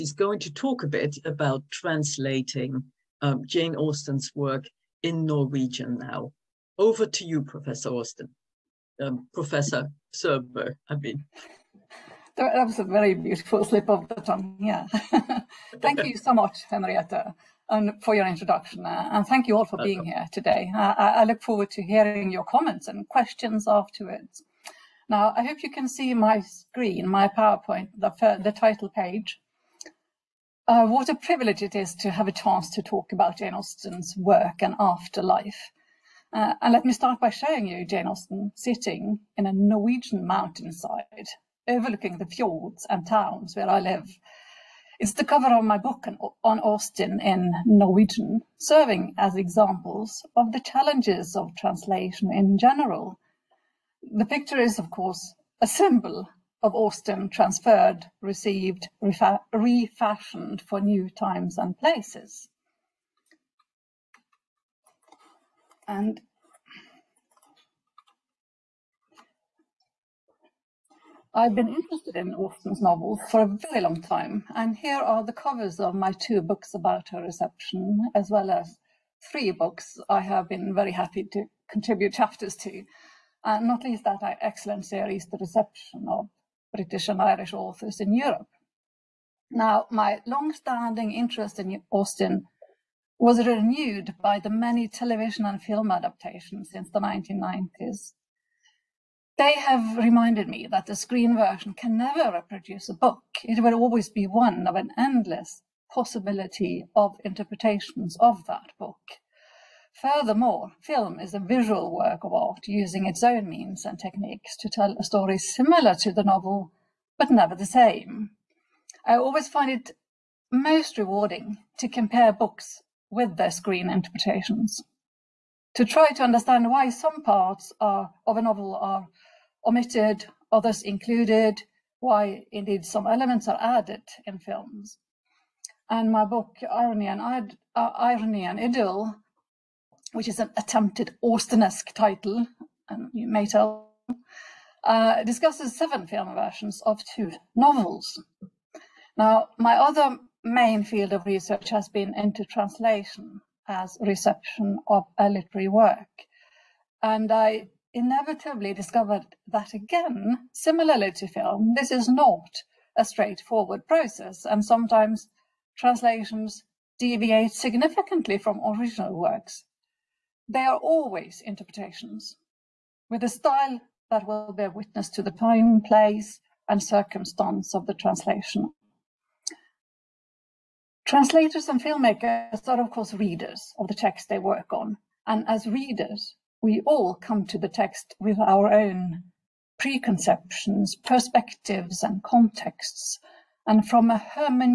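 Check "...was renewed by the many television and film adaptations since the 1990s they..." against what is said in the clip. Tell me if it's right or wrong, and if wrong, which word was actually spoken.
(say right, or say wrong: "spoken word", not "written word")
right.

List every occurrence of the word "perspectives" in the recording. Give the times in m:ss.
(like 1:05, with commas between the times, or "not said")
3:10.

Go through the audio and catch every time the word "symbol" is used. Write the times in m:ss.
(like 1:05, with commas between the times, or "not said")
0:55.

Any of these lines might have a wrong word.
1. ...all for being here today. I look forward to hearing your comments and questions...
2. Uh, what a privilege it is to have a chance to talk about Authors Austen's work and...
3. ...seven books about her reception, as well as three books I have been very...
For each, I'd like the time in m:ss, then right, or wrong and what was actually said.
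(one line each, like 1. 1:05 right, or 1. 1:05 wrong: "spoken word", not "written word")
1. 0:19 right
2. 0:30 wrong: "Jane", not "Authors"
3. 1:16 wrong: "two", not "seven".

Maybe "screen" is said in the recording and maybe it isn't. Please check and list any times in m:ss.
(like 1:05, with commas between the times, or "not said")
0:26, 1:40, 2:03.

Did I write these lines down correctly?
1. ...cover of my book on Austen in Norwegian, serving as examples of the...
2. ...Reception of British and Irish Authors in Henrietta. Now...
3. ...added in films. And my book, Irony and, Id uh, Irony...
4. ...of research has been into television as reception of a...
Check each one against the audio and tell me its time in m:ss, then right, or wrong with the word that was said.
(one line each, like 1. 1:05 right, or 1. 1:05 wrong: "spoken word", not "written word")
1. 0:45 right
2. 1:25 wrong: "Europe", not "Henrietta"
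3. 2:13 right
4. 2:31 wrong: "translation", not "television".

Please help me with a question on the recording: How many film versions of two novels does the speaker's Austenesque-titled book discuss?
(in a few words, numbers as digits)
7.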